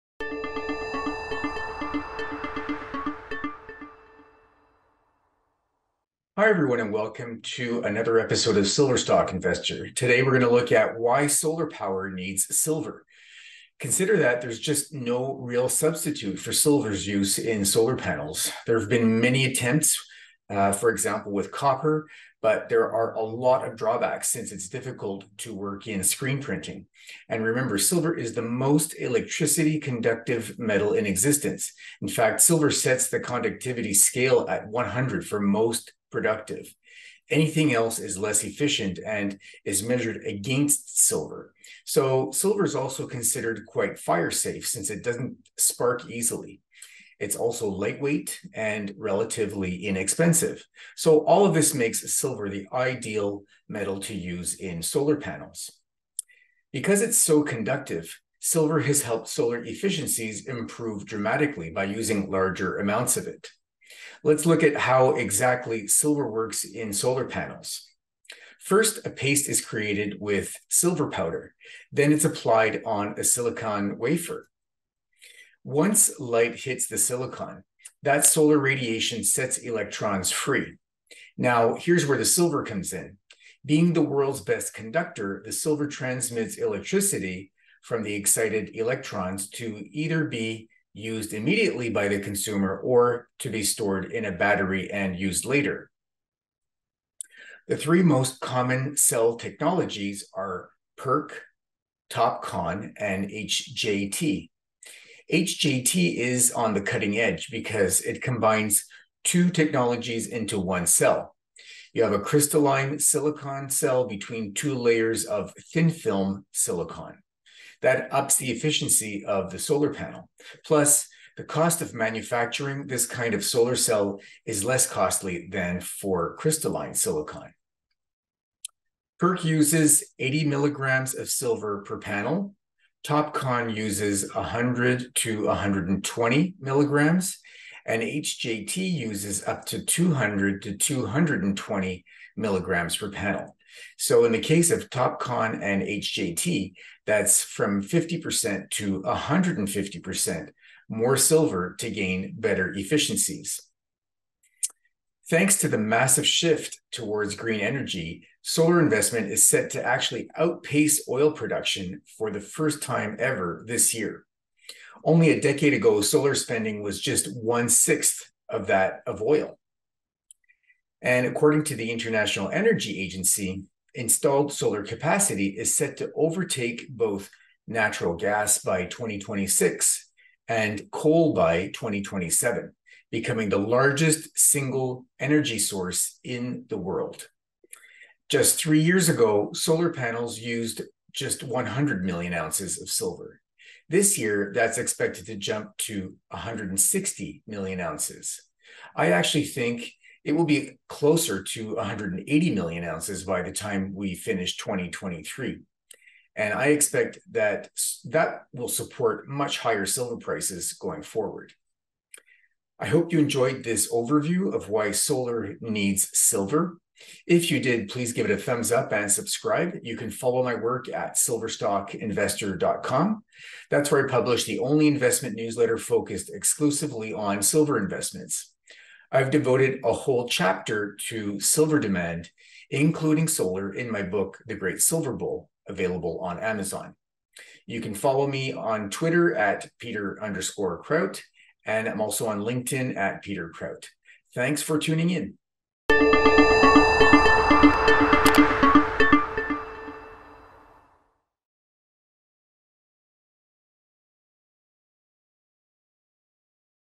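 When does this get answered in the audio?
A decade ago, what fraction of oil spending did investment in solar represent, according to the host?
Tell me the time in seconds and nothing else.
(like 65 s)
167 s.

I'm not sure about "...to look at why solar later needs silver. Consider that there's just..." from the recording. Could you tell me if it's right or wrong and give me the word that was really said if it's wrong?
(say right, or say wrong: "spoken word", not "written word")
wrong: "power", not "later".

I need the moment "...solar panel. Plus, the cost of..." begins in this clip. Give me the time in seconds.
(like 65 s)
119 s.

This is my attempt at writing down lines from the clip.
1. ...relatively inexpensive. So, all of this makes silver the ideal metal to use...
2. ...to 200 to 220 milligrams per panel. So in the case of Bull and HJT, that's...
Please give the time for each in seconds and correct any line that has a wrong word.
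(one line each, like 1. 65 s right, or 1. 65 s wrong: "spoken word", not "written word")
1. 48 s right
2. 139 s wrong: "TopCon", not "Bull".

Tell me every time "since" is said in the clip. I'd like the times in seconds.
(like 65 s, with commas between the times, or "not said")
24 s, 44 s.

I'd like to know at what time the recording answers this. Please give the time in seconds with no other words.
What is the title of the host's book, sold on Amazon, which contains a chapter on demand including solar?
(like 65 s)
234 s.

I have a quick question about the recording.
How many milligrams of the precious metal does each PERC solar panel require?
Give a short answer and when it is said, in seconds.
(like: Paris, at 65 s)
80 milligrams, at 130 s.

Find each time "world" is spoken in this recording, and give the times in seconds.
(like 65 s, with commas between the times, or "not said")
84 s, 186 s.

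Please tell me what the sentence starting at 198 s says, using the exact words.
I actually think it will be closer to 180 million ounces by the time we finish 2023.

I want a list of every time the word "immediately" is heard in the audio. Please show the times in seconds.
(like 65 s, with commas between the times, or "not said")
91 s.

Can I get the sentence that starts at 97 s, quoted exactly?
The three most common cell technologies are PERC, TOPCon, and HJT.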